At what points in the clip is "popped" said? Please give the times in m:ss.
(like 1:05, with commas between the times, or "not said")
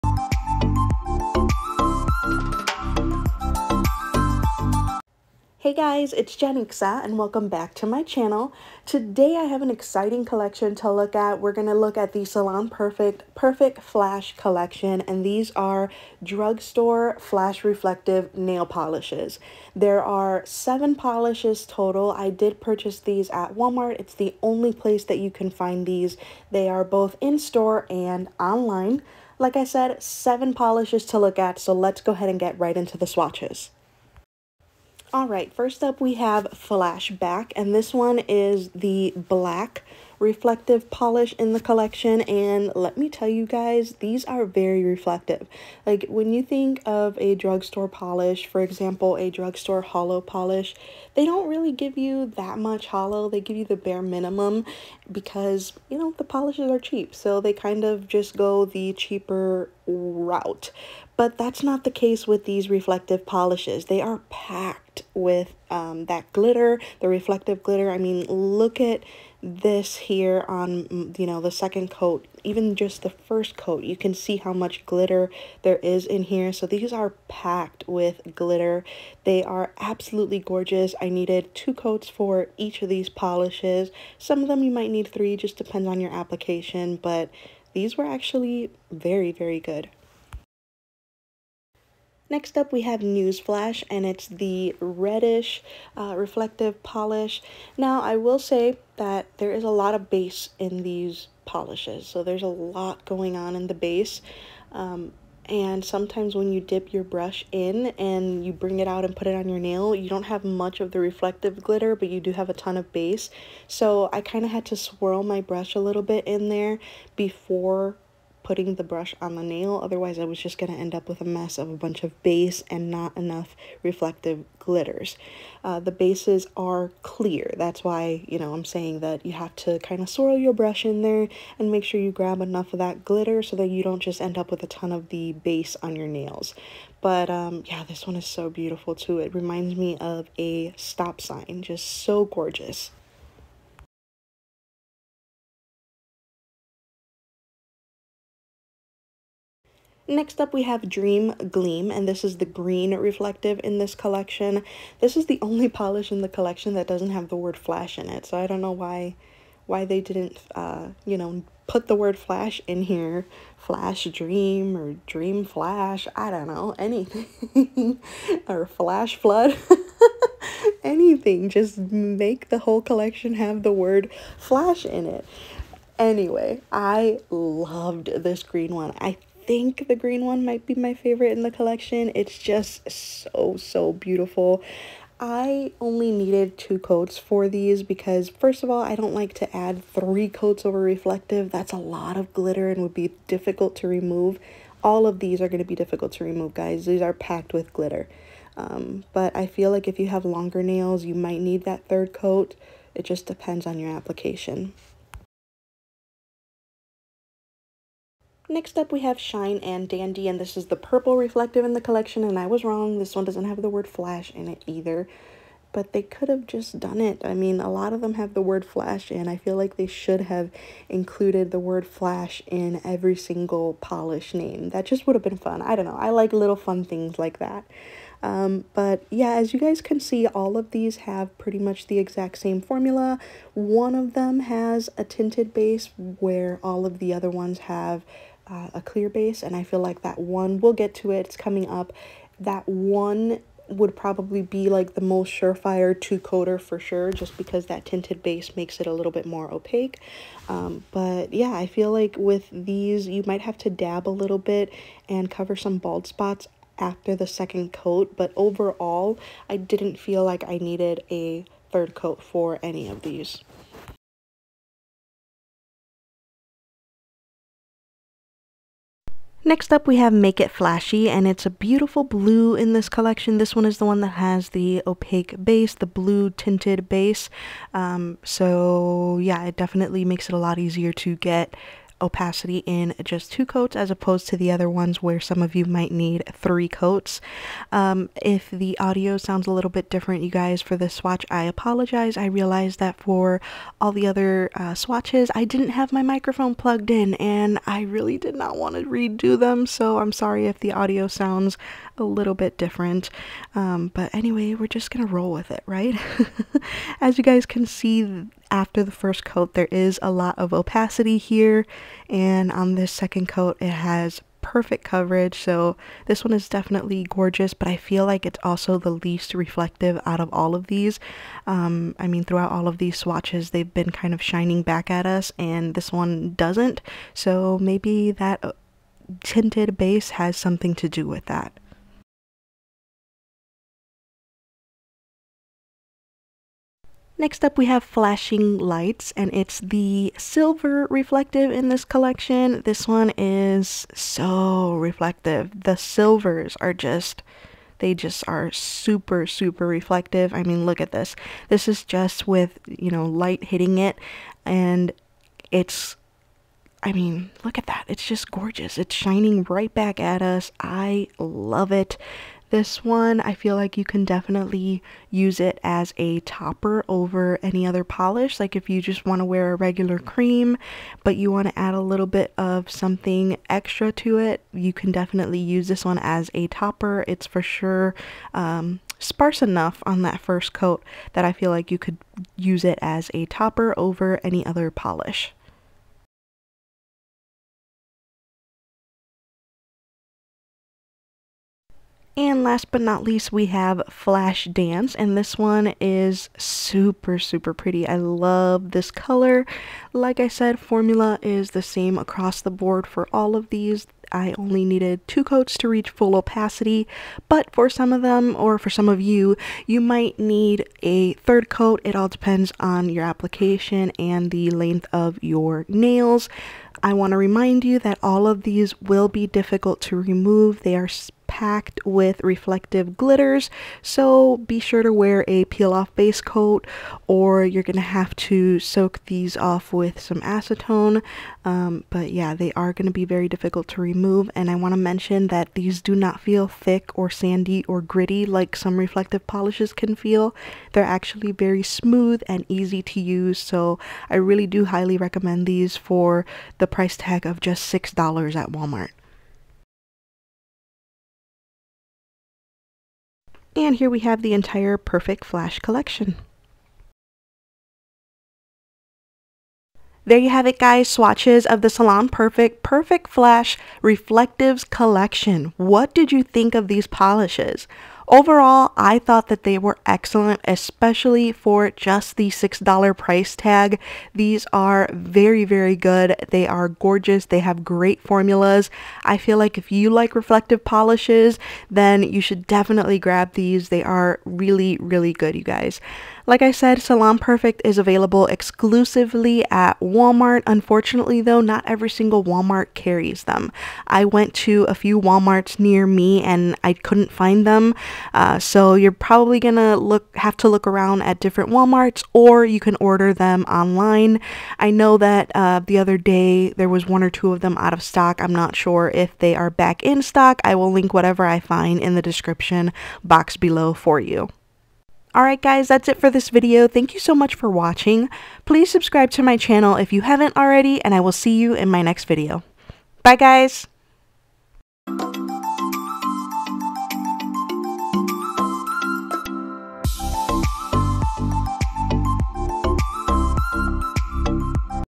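not said.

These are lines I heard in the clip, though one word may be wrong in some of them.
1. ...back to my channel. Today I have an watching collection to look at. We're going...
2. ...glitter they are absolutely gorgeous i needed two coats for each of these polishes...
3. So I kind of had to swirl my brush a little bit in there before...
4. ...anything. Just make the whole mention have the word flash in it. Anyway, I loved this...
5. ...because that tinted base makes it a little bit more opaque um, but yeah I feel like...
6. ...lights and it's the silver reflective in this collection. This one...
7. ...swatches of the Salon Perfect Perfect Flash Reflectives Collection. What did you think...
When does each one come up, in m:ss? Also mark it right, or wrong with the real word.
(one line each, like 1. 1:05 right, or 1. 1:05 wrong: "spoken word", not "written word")
1. 0:07 wrong: "exciting", not "watching"
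2. 1:18 right
3. 1:53 right
4. 2:50 wrong: "collection", not "mention"
5. 4:07 right
6. 5:38 right
7. 7:40 right.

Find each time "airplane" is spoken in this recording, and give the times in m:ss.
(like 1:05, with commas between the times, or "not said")
not said.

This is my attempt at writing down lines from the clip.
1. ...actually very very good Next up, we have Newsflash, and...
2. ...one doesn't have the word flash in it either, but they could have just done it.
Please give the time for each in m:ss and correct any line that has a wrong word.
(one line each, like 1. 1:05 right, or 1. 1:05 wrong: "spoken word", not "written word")
1. 1:28 right
2. 3:33 right.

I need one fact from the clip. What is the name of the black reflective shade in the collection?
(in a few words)
Flashback.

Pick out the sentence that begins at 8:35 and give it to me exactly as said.
Alright guys, that's it for this video.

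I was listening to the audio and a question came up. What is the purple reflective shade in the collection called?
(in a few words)
Shine and Dandy.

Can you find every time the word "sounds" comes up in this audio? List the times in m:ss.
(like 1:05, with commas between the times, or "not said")
4:49, 5:01.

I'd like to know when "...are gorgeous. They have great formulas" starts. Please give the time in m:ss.
7:56.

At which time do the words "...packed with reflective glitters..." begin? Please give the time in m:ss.
7:01.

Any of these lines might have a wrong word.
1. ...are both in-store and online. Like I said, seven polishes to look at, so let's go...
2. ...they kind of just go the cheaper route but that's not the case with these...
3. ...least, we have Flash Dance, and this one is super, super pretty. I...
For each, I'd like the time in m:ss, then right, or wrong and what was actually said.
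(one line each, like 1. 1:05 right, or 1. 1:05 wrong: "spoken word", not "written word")
1. 0:26 right
2. 0:57 right
3. 6:33 right.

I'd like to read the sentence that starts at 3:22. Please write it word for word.
It just depends on your application.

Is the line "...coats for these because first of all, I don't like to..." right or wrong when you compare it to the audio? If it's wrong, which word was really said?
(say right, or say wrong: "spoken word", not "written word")
right.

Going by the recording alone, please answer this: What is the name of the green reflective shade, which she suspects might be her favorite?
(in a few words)
Dream Gleam.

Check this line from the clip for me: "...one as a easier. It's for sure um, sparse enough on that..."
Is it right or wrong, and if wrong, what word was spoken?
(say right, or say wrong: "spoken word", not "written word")
wrong: "topper", not "easier".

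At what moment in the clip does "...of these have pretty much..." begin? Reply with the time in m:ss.
3:50.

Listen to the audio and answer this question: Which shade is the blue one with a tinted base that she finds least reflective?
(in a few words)
Make It Flashy.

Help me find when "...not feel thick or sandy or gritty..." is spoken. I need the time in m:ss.
7:15.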